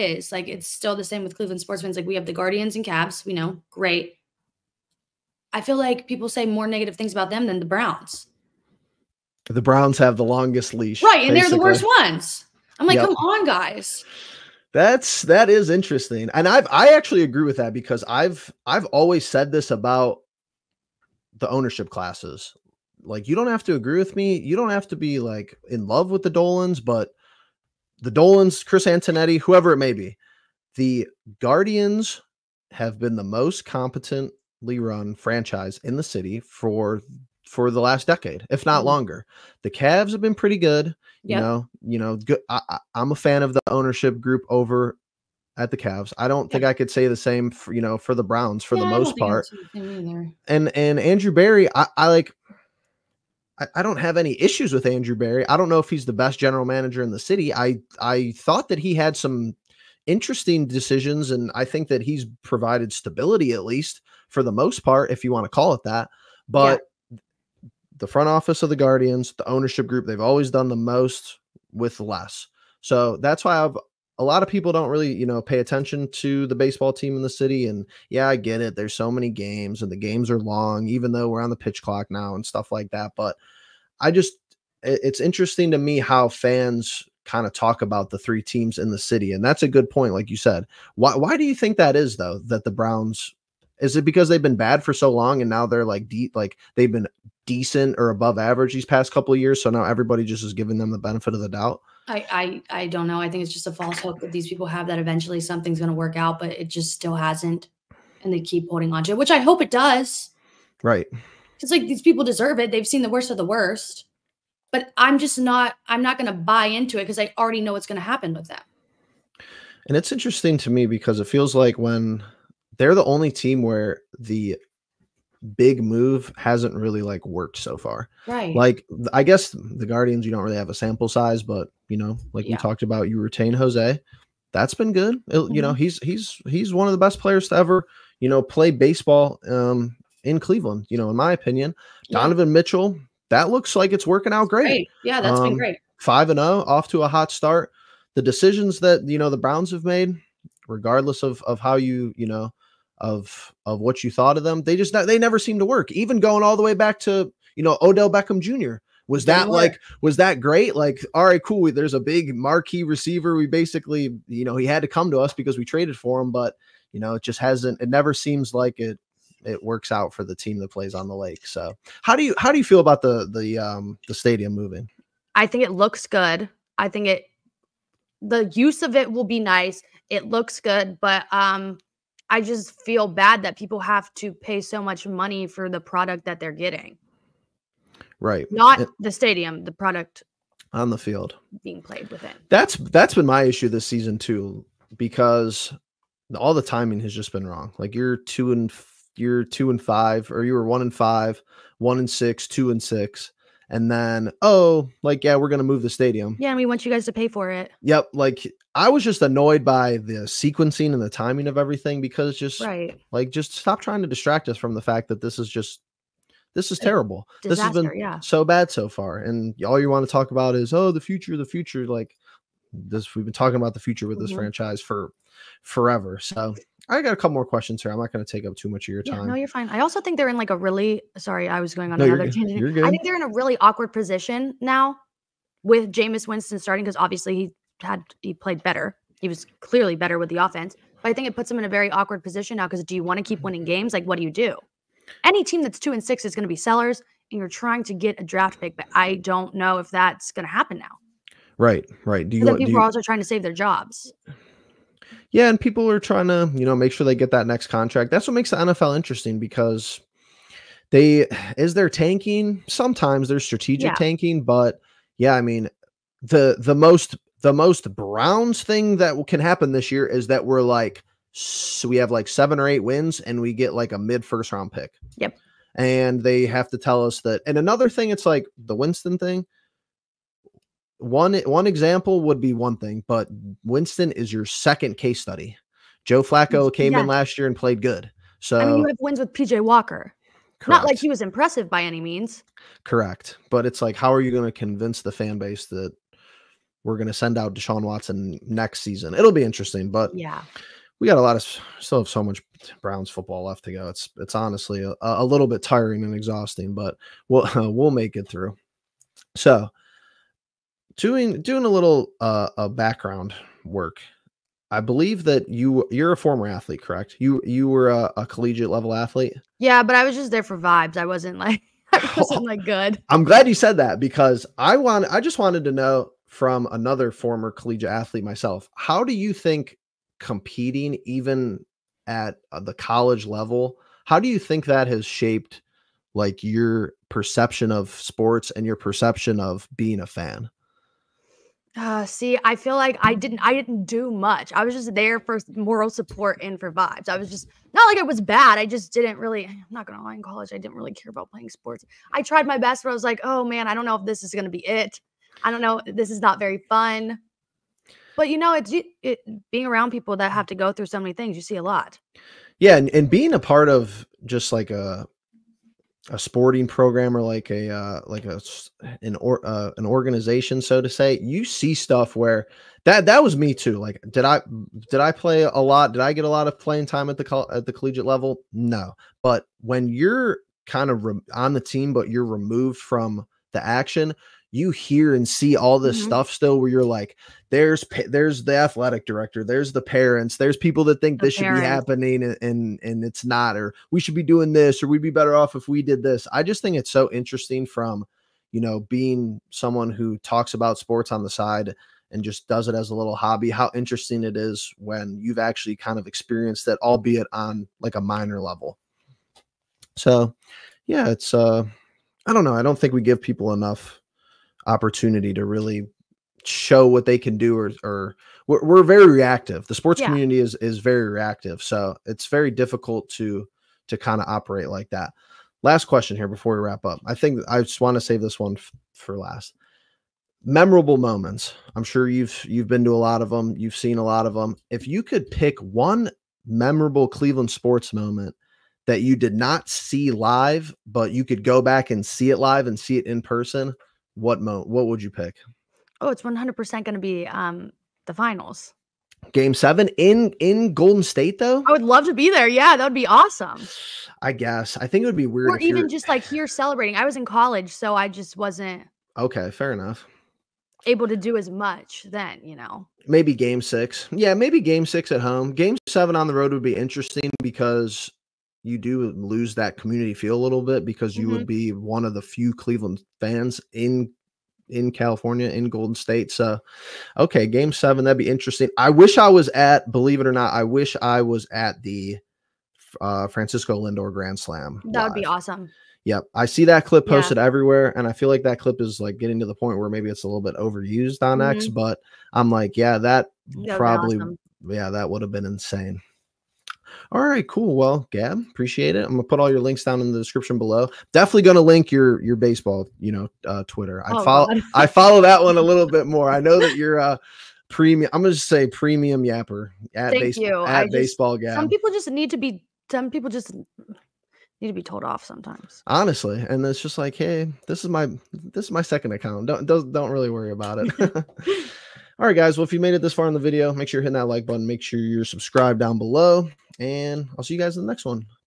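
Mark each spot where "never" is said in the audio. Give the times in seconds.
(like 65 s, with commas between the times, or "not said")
155 s, 167 s.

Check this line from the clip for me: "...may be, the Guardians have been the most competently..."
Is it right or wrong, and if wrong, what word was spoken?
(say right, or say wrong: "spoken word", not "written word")
right.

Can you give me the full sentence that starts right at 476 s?
So, okay, game seven that'd be interesting.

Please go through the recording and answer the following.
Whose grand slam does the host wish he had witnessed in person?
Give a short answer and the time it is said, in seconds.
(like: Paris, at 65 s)
Francisco Lindor, at 483 s.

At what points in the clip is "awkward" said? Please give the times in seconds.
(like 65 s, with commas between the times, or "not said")
233 s, 241 s.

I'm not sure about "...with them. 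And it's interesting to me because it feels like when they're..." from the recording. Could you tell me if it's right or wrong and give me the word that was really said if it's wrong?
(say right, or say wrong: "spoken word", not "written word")
right.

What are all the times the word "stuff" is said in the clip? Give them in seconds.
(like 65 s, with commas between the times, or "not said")
82 s, 371 s, 386 s.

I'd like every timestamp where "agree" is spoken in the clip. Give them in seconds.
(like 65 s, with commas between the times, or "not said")
17 s, 23 s.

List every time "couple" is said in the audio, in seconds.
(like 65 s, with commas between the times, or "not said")
99 s, 227 s.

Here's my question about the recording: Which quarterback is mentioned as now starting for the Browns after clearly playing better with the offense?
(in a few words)
Jameis Winston.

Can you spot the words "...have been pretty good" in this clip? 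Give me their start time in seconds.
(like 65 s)
40 s.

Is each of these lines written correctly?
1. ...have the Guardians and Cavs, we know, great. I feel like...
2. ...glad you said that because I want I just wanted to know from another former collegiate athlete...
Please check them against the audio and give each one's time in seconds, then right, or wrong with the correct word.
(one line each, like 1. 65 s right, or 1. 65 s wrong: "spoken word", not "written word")
1. 2 s right
2. 323 s right.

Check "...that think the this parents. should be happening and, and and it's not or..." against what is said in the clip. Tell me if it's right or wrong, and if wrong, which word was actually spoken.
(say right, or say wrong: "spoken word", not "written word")
right.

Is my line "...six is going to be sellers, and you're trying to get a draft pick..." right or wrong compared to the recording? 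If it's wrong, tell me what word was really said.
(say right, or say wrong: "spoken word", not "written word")
right.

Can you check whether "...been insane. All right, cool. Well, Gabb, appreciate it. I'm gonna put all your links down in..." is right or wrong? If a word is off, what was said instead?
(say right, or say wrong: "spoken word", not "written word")
right.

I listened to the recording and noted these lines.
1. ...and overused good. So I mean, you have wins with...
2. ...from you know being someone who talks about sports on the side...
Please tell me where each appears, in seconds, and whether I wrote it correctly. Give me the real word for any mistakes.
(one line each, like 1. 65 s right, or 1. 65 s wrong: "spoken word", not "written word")
1. 287 s wrong: "played", not "overused"
2. 397 s right.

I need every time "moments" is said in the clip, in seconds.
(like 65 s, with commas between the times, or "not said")
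430 s, 437 s.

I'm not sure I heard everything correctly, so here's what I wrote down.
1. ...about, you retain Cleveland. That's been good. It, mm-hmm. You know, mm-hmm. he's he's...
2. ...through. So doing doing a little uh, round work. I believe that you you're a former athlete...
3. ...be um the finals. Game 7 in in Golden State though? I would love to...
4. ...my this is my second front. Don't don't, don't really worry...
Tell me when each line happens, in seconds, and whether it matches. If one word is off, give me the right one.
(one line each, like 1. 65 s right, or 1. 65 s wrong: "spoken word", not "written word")
1. 132 s wrong: "Jose", not "Cleveland"
2. 308 s wrong: "background", not "round"
3. 446 s right
4. 517 s wrong: "account", not "front".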